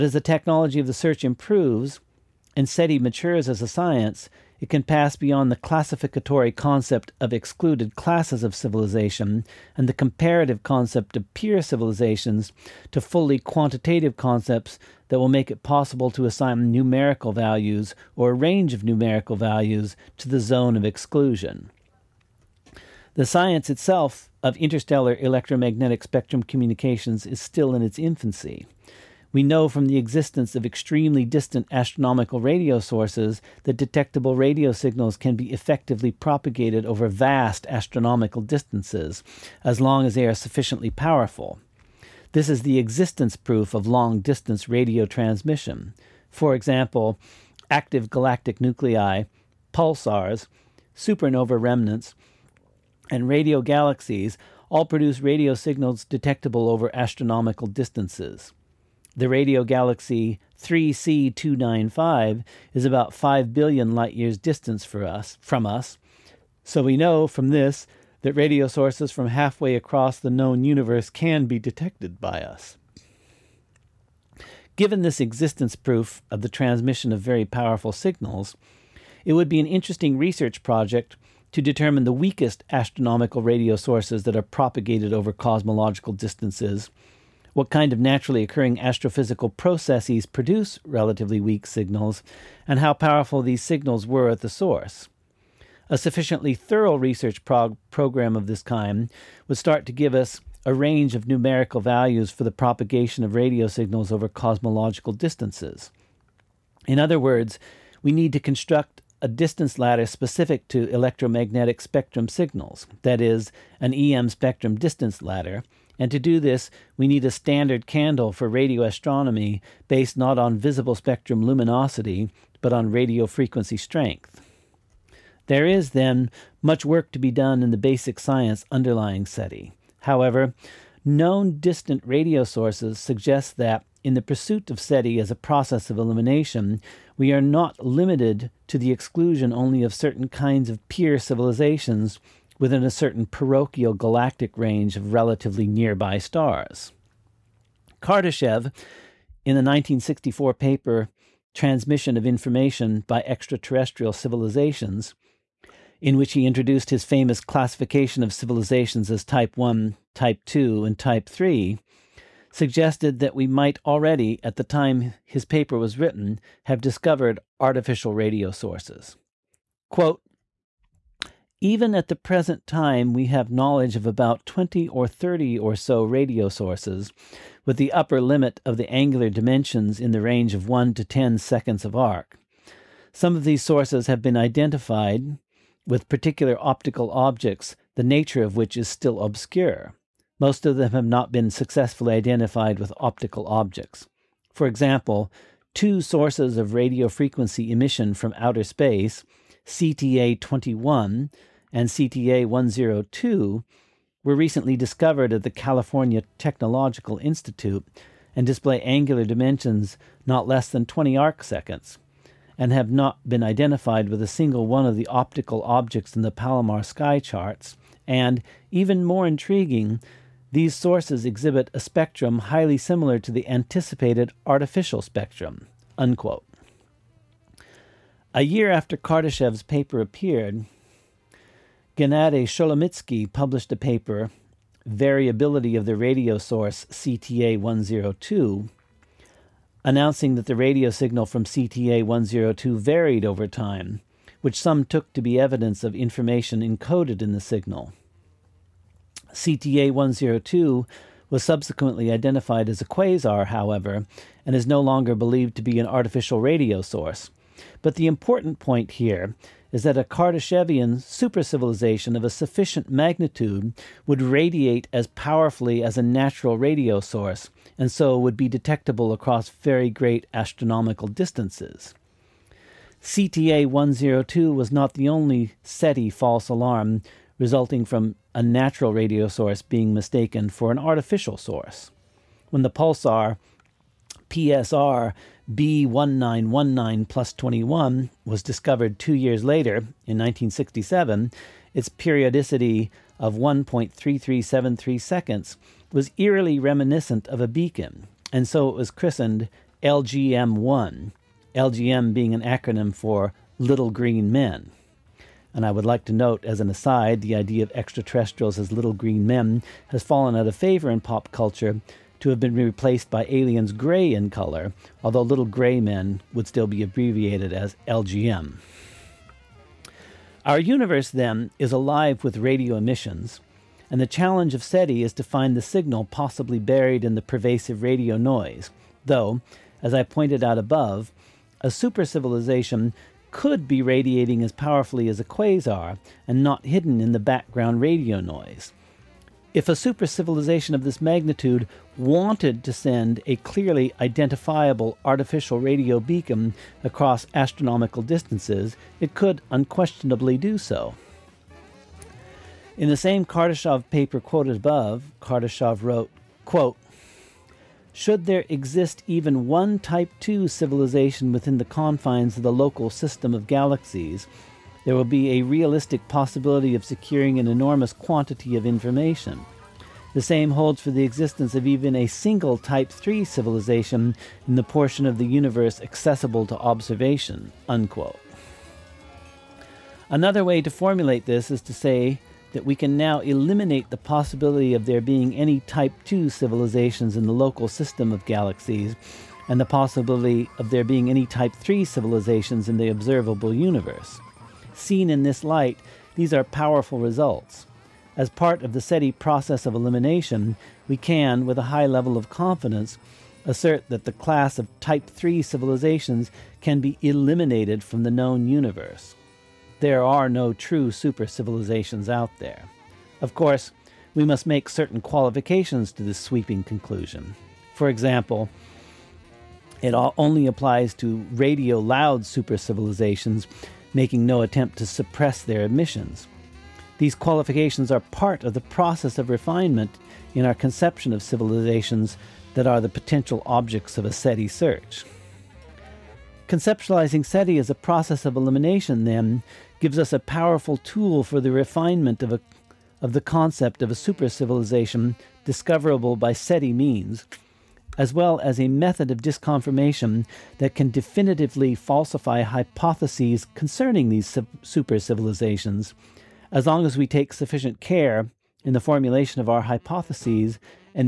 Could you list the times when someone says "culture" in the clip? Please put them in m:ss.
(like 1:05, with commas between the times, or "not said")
5:11.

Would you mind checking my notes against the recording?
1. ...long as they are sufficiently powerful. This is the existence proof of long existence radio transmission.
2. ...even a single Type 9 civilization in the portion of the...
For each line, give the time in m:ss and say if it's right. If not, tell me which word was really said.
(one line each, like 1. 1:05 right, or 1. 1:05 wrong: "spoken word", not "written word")
1. 0:39 wrong: "distance", not "existence"
2. 6:11 wrong: "3", not "9".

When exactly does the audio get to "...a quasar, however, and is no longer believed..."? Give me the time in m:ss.
4:12.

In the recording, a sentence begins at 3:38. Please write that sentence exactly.
And even more intriguing, these sources exhibit a spectrum highly similar to the anticipated artificial spectrum.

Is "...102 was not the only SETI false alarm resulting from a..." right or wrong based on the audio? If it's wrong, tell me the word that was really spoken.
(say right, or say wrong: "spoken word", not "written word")
right.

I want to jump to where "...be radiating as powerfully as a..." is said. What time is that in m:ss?
5:33.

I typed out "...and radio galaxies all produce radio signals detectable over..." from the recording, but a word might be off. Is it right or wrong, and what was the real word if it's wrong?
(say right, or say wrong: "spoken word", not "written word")
right.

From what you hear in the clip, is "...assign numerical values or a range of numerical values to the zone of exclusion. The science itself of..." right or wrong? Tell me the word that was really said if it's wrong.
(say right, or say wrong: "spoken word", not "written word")
right.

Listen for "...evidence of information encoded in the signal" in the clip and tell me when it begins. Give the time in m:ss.
4:05.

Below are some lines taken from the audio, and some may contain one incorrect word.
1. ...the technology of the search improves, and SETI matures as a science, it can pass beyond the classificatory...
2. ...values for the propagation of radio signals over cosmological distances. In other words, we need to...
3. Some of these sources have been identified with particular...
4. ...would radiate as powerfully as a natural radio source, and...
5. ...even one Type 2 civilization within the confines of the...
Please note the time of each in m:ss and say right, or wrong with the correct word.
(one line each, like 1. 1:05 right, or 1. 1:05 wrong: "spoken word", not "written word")
1. 0:00 right
2. 1:41 right
3. 3:03 right
4. 4:24 right
5. 5:59 right.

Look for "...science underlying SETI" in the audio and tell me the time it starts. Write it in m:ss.
2:08.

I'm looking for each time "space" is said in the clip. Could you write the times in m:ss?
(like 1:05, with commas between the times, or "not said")
3:18.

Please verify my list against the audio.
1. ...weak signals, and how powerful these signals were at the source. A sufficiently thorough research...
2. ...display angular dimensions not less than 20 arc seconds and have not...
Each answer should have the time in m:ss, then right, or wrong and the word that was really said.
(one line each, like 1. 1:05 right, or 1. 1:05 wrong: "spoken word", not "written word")
1. 1:31 right
2. 3:28 right.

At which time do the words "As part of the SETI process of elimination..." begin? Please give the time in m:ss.
6:38.